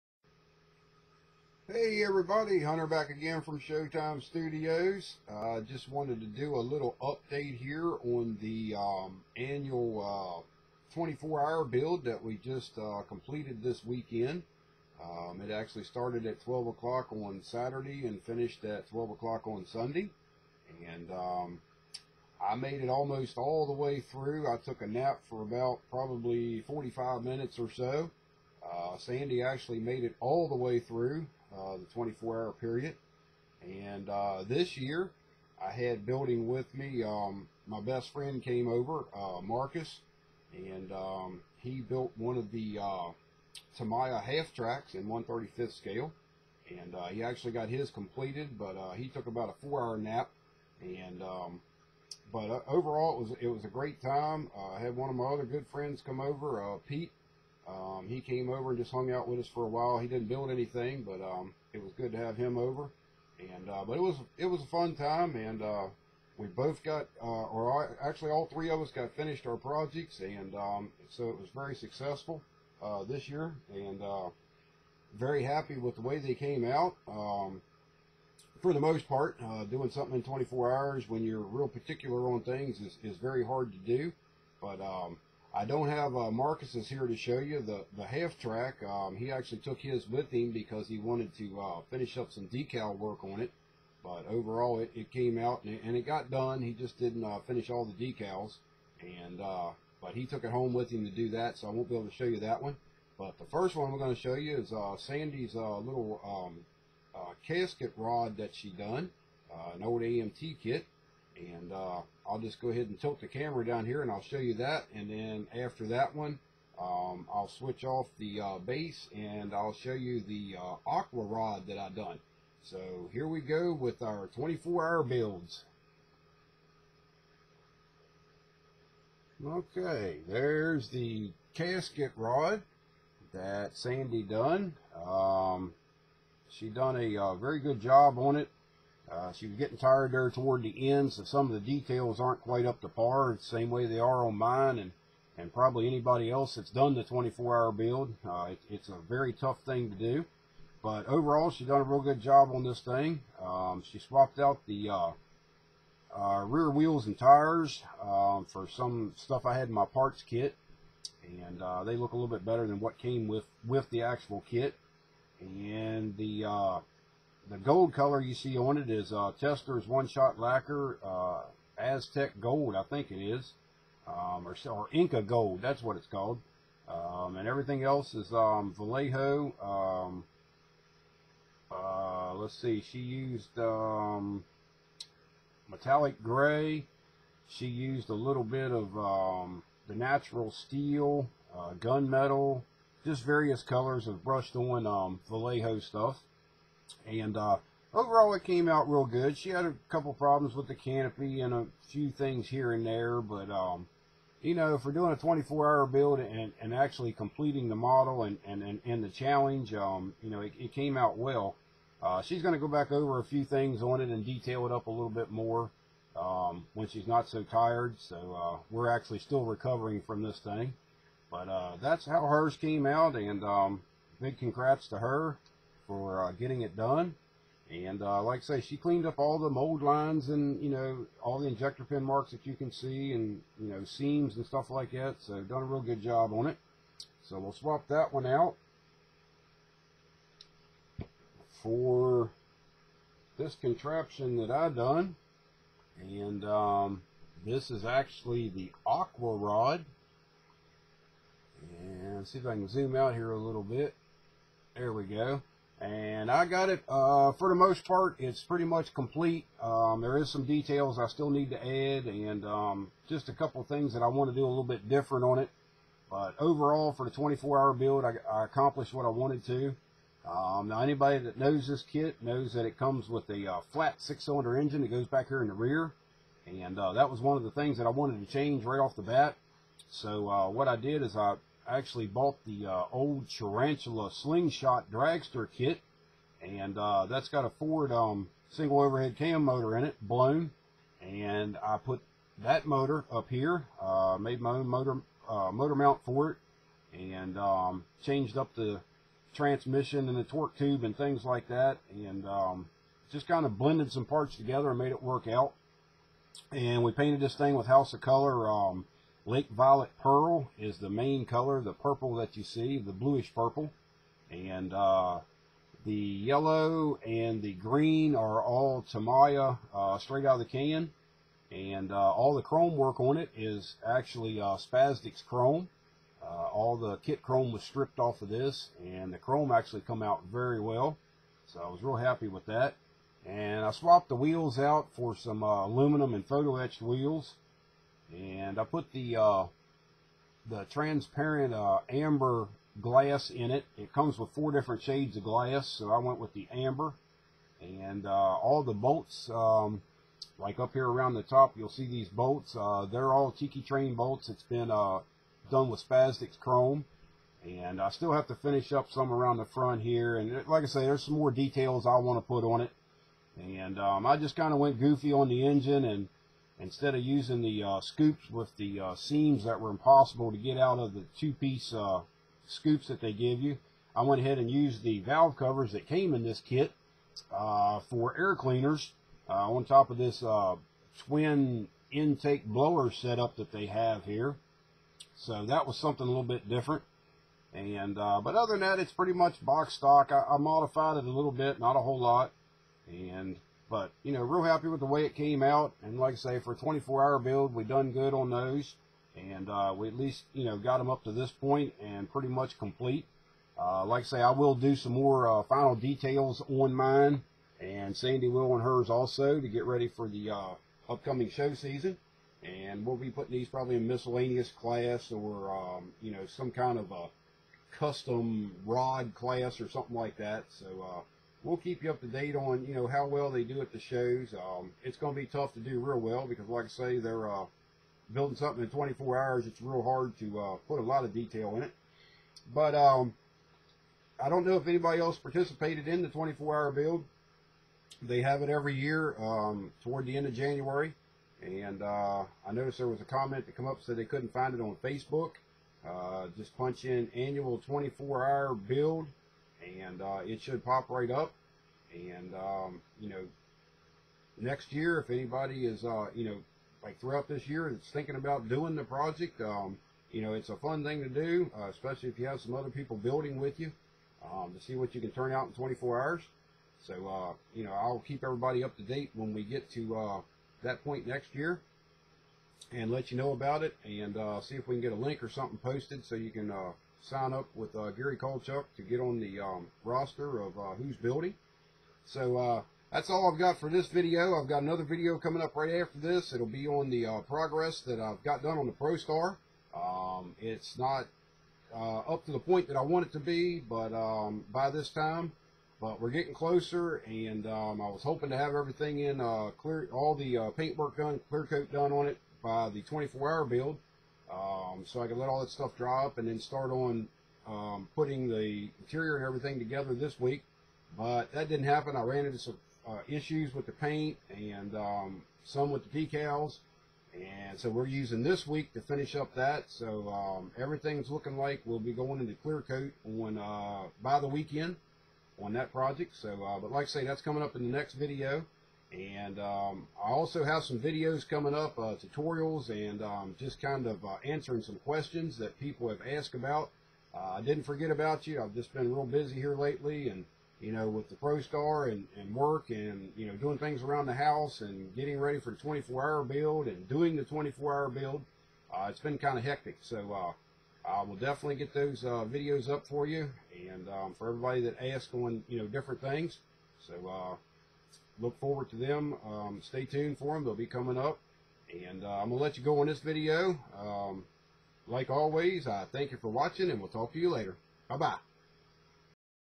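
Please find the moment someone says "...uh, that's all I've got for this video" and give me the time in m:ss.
8:02.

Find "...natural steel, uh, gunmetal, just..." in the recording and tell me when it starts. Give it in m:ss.
3:09.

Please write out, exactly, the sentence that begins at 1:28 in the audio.
Um, he actually took his with him because he wanted to uh, finish up some decal work on it.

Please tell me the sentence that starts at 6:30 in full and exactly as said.
I, I modified it a little bit, not a whole lot.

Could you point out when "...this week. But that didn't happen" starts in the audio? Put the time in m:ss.
8:29.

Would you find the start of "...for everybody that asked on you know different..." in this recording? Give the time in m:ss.
9:14.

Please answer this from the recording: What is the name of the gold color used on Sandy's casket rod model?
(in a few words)
Inca Gold.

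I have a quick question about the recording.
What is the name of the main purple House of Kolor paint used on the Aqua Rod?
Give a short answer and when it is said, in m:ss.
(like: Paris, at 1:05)
Lake Violet Pearl, at 5:09.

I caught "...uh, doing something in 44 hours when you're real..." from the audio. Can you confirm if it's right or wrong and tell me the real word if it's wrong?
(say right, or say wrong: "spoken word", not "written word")
wrong: "24", not "44".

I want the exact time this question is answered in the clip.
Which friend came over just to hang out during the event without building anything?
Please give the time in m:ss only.
0:56.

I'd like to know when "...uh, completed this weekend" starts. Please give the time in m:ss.
0:12.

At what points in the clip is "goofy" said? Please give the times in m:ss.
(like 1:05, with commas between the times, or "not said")
6:04.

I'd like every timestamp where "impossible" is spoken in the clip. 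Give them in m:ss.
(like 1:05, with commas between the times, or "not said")
6:09.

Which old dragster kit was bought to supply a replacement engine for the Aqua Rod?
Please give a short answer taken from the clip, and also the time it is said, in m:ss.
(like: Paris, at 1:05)
Tarantula Slingshot Dragster, at 4:43.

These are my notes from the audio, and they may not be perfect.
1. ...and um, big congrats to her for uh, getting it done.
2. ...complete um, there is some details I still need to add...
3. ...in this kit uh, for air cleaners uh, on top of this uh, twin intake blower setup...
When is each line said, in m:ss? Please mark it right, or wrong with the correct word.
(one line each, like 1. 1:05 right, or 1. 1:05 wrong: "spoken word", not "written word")
1. 3:43 right
2. 4:18 right
3. 6:16 right.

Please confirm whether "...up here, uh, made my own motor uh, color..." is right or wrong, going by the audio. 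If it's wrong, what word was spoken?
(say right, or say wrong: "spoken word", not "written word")
wrong: "motor", not "color".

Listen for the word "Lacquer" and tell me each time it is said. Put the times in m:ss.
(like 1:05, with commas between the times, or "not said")
2:50.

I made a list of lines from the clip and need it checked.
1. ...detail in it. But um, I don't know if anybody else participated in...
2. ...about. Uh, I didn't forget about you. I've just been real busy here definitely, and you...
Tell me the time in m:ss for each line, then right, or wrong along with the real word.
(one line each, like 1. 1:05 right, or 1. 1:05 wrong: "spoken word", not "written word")
1. 7:11 right
2. 8:56 wrong: "lately", not "definitely".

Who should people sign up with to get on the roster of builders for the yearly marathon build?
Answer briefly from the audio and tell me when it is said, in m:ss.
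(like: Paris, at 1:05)
Gary Kolchuk, at 7:57.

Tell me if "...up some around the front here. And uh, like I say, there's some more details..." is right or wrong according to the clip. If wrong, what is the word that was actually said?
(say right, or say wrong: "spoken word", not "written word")
right.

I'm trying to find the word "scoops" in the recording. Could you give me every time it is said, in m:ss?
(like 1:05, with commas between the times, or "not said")
6:07, 6:12.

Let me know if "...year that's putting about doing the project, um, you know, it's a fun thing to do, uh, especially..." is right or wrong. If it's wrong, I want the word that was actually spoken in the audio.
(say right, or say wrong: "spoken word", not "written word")
wrong: "thinking", not "putting".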